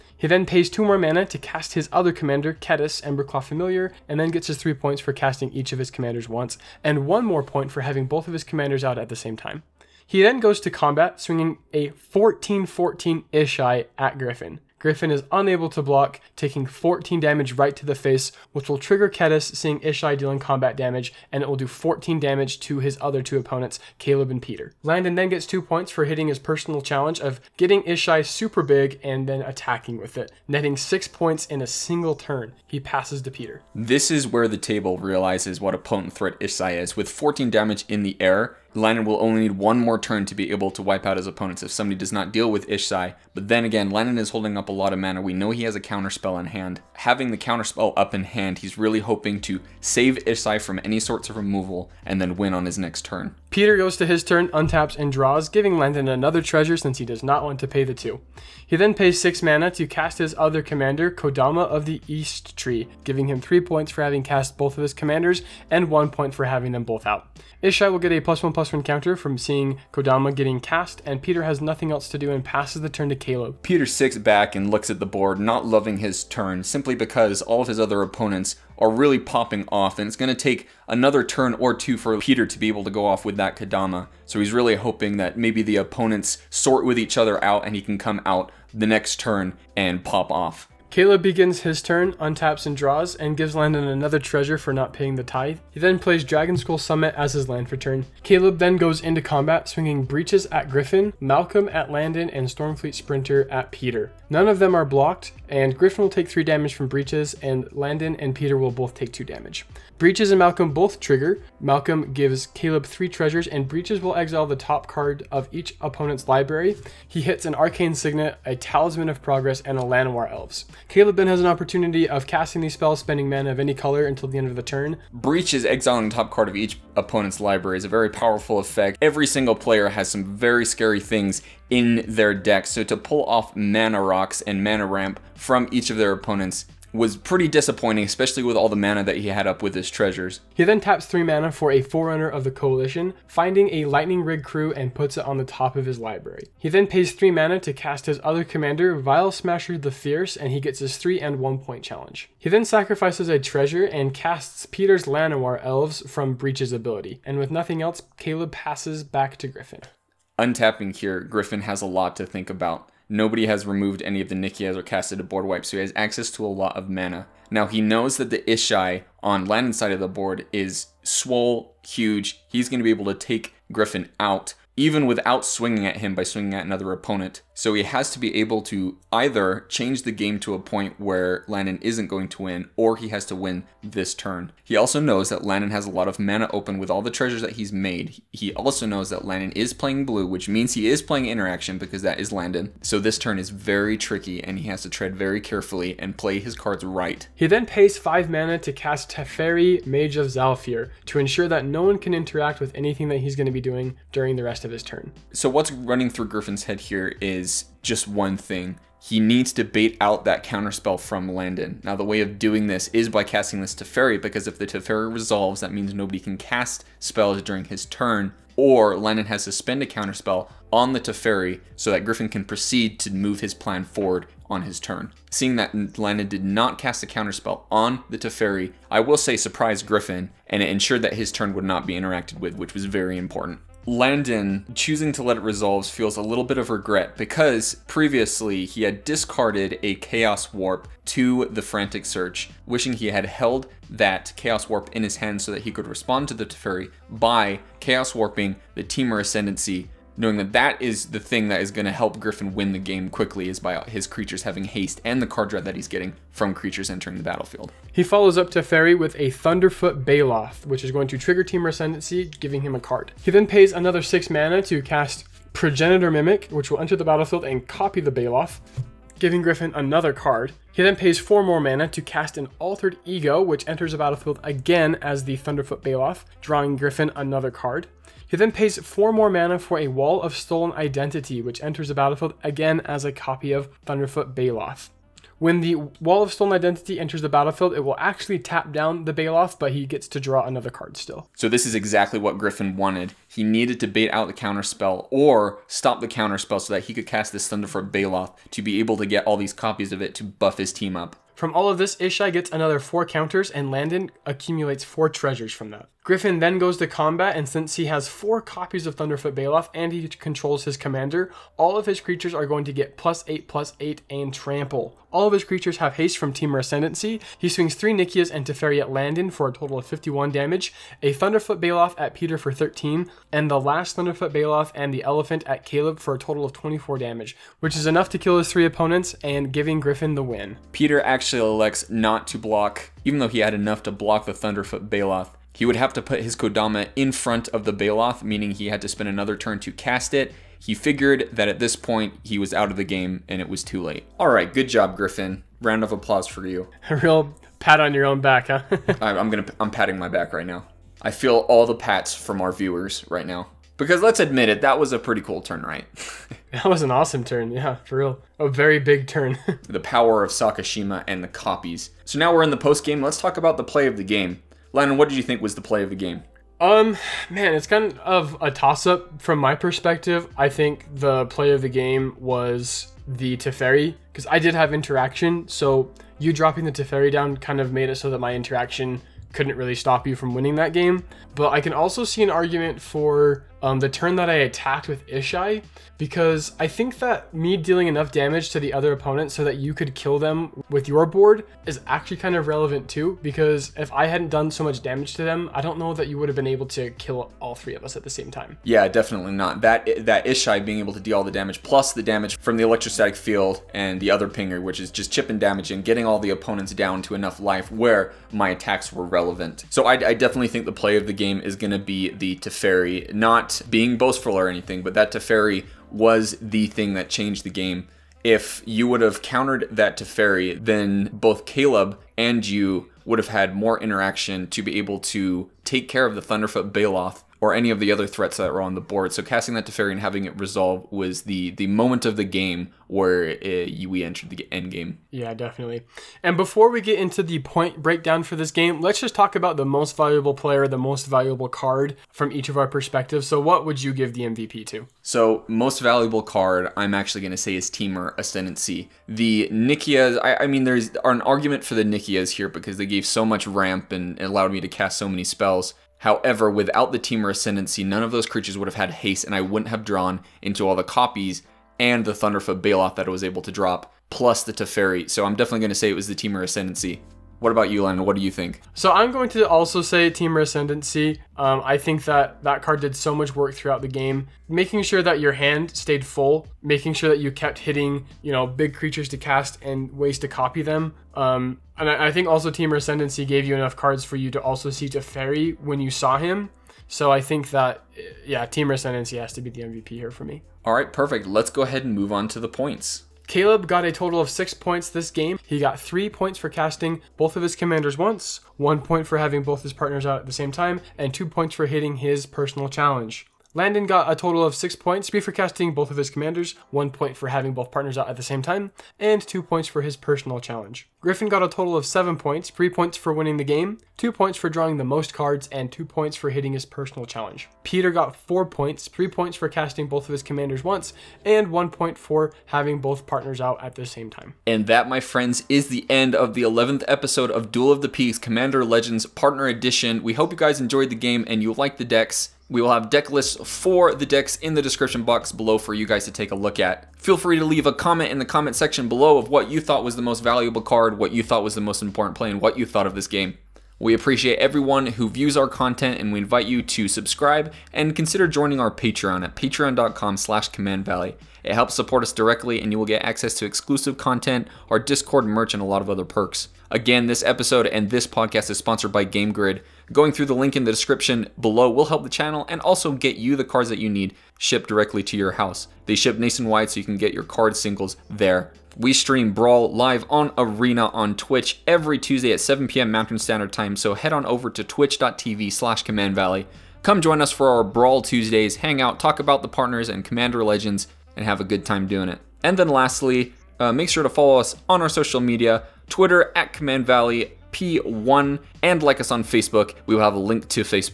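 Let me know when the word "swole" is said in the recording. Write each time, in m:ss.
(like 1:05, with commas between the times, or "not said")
2:51.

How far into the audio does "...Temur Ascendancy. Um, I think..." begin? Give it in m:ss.
7:50.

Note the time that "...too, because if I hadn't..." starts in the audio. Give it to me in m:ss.
6:32.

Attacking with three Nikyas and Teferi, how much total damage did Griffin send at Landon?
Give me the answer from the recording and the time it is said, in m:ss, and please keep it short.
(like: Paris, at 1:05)
51, at 5:19.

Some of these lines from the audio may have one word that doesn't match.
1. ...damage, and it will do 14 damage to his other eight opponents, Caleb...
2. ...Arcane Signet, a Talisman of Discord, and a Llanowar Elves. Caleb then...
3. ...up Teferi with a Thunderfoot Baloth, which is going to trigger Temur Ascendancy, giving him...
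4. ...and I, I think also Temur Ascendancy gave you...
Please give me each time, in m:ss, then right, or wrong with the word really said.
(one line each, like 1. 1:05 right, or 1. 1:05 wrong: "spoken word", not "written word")
1. 0:20 wrong: "two", not "eight"
2. 1:57 wrong: "Progress", not "Discord"
3. 4:18 right
4. 8:01 right.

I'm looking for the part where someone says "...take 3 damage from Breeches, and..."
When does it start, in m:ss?
1:46.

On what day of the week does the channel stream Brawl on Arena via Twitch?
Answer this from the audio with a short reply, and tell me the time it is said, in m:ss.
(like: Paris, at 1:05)
Tuesday, at 9:31.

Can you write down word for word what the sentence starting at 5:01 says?
From all of this, Ishai gets another four counters, and Landon accumulates four treasures from that.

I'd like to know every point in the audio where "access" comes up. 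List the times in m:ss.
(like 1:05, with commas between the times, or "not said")
2:45, 9:13.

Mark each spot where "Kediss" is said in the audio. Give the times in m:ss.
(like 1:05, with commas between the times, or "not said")
0:02, 0:19.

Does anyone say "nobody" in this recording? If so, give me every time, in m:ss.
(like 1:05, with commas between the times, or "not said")
2:43, 3:35.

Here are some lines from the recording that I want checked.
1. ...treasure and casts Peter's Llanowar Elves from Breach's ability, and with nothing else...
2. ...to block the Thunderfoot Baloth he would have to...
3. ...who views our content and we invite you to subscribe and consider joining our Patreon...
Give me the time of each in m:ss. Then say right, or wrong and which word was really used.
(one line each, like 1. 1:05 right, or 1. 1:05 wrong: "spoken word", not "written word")
1. 2:33 right
2. 5:33 right
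3. 9:04 right.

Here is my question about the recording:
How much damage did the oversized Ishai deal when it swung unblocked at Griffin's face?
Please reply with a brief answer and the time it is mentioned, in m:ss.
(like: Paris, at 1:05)
14, at 0:16.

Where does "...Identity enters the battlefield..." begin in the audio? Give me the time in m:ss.
4:46.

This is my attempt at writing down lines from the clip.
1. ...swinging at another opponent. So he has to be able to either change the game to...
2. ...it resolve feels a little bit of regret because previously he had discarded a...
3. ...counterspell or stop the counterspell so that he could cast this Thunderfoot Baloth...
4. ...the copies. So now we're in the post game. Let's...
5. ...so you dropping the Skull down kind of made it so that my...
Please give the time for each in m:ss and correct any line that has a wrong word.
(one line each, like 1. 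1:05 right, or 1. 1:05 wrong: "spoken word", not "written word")
1. 2:56 right
2. 3:55 right
3. 4:54 right
4. 6:01 right
5. 6:15 wrong: "Teferi", not "Skull".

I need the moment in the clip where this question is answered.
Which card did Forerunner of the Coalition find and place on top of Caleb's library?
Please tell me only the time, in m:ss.
2:23.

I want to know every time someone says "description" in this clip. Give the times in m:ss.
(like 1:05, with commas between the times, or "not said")
8:54, 9:20.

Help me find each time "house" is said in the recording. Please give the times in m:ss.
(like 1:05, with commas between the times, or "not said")
9:25.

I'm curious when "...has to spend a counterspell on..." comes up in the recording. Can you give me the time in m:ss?
3:39.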